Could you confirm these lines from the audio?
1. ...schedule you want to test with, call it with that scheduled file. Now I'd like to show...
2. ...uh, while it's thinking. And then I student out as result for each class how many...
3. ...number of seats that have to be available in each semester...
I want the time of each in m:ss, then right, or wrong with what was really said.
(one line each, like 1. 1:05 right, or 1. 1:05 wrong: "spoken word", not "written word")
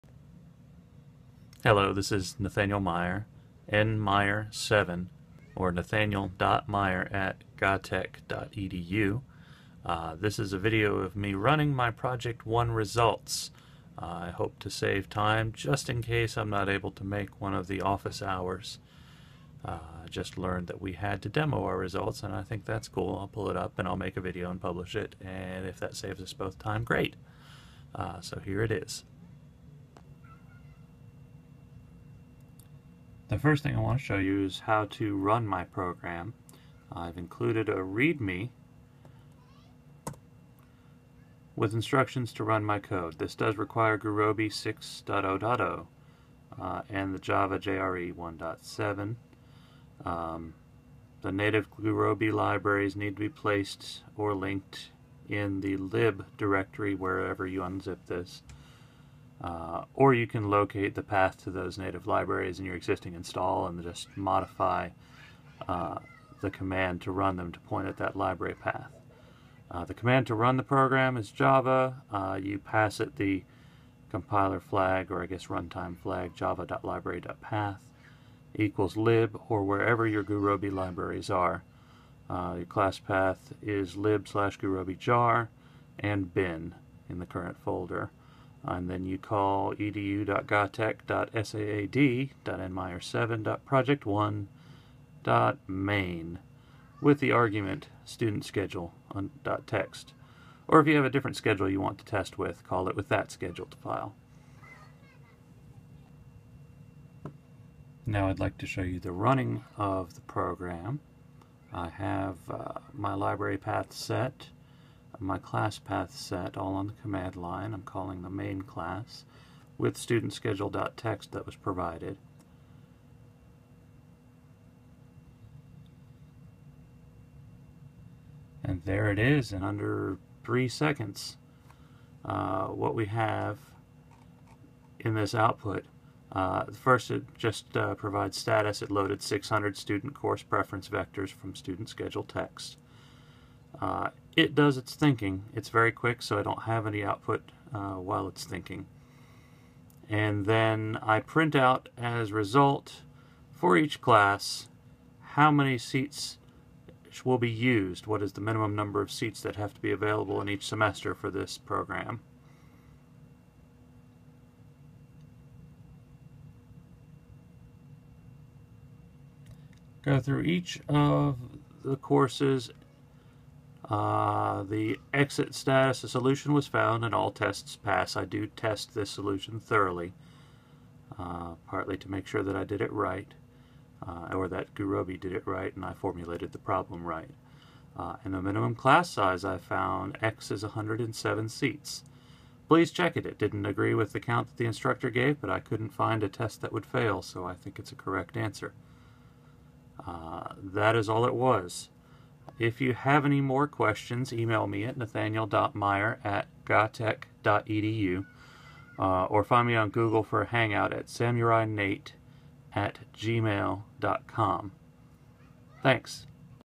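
1. 1:41 right
2. 2:27 wrong: "print", not "student"
3. 2:38 right.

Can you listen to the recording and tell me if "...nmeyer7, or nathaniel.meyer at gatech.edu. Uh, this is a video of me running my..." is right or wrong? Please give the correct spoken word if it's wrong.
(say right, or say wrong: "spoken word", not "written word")
right.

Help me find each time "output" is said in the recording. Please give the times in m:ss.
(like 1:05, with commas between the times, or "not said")
2:15, 2:27.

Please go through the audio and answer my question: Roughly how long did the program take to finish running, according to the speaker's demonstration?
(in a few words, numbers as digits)
under 3 seconds.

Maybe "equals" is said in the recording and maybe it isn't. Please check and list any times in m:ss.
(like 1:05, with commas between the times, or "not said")
1:18.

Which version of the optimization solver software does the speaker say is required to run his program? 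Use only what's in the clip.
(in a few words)
6.0.0.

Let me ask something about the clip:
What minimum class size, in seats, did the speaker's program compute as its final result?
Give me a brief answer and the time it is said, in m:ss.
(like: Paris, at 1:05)
107, at 3:10.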